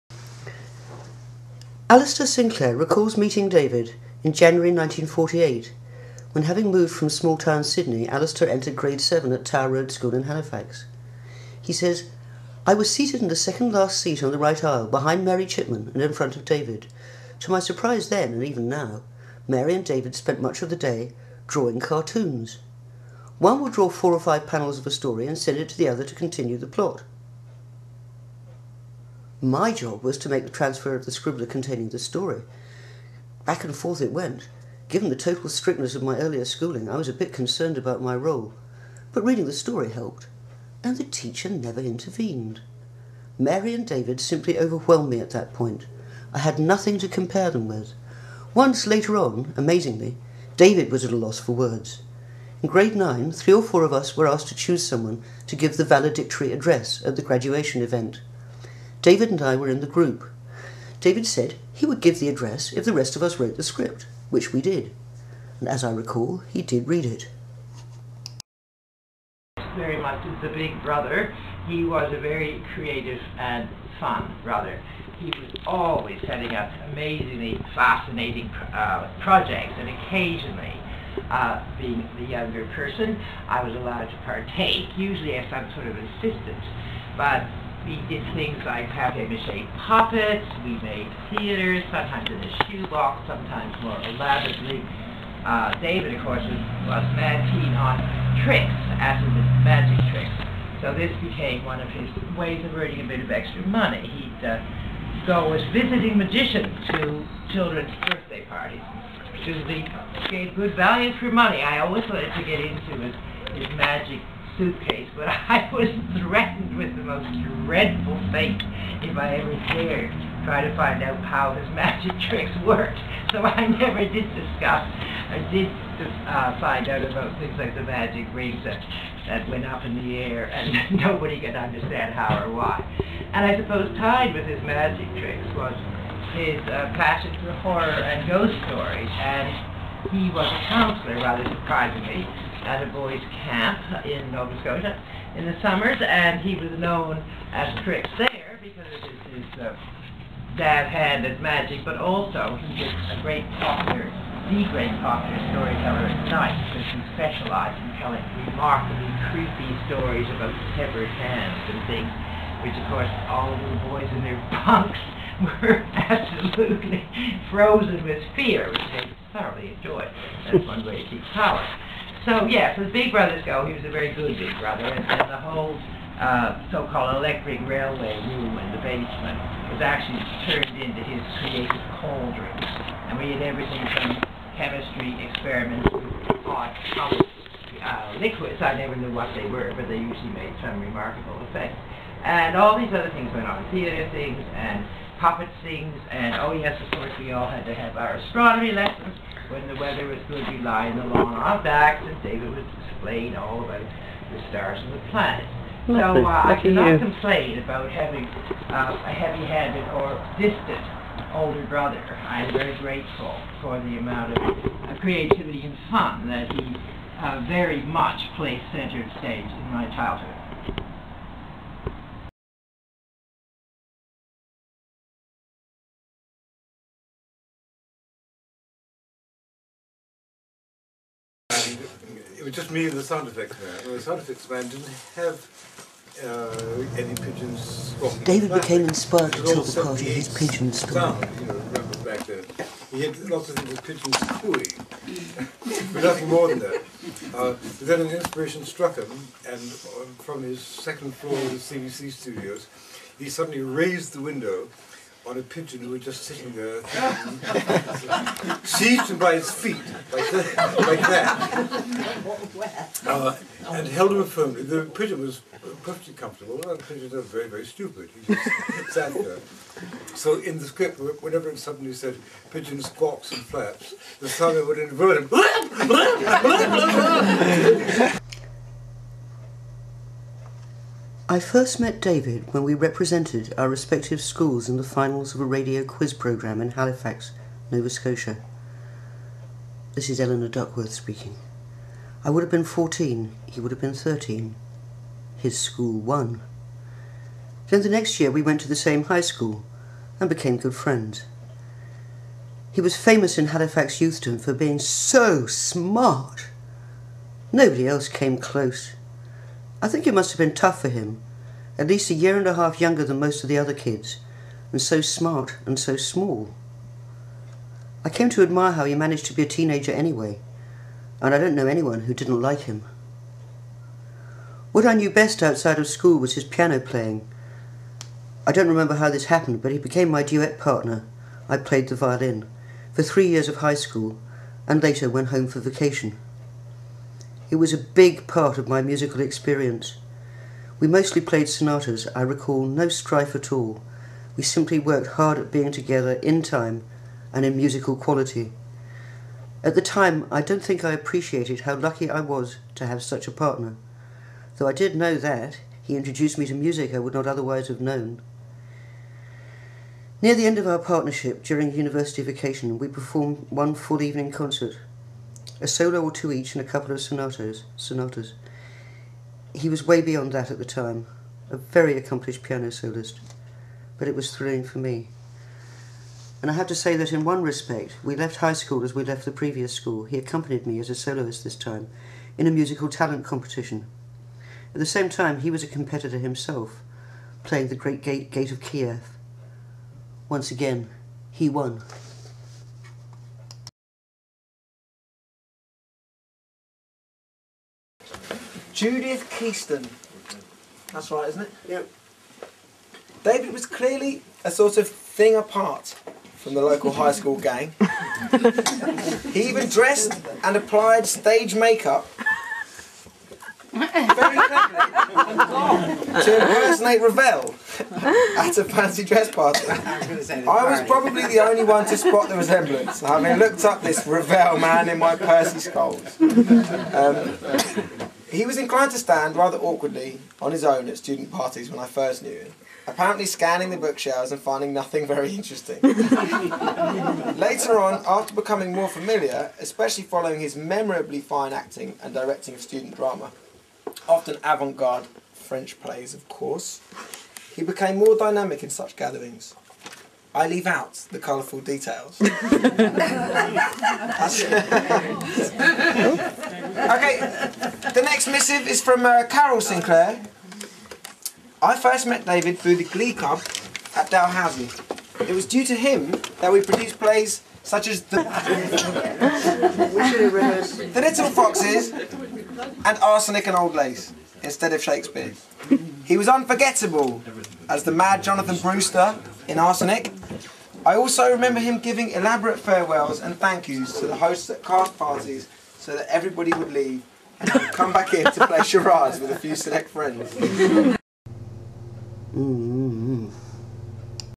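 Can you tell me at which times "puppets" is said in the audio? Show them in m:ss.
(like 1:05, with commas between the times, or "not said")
1:29, 3:15.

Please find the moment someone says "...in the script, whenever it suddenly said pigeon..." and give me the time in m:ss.
4:30.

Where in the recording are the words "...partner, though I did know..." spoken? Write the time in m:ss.
5:53.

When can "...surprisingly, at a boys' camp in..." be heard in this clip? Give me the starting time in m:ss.
2:21.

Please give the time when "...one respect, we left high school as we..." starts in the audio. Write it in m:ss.
6:17.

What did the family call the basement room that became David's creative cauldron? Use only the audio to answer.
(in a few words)
electric railway room.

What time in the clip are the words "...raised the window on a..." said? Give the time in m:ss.
4:13.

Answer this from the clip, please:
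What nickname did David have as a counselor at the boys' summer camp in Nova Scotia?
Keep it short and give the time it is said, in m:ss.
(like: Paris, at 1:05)
Trix, at 2:27.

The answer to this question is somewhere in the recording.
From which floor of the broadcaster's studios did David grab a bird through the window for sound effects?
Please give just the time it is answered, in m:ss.
4:10.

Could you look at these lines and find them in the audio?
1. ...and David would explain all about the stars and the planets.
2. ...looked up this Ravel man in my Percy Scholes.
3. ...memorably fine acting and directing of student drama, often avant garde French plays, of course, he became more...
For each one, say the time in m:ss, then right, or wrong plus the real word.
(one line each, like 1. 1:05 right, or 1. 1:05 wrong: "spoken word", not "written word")
1. 3:22 right
2. 7:03 right
3. 7:20 right.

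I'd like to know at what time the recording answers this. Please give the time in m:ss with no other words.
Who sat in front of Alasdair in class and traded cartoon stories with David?
0:15.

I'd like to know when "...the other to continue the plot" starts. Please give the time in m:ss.
0:25.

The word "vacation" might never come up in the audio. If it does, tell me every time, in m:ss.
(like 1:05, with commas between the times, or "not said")
5:35, 6:02.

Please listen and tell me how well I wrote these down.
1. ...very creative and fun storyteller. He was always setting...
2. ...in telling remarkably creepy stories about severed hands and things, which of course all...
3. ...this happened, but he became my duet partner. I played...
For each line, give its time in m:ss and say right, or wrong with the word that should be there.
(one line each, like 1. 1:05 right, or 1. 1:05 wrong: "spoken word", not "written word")
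1. 1:12 wrong: "brother", not "storyteller"
2. 2:37 right
3. 5:29 right.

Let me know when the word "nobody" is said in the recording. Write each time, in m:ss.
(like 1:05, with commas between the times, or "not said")
2:11, 5:07.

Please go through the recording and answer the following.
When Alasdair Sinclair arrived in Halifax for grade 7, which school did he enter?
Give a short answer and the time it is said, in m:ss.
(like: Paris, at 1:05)
Tower Road School, at 0:09.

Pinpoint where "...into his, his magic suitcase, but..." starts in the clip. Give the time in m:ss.
1:52.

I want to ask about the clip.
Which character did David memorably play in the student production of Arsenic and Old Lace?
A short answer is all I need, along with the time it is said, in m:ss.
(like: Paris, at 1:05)
Jonathan Brewster, at 7:58.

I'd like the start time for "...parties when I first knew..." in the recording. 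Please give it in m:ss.
7:11.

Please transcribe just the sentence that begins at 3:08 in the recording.
I never knew what they were, but they usually made some remarkable effect.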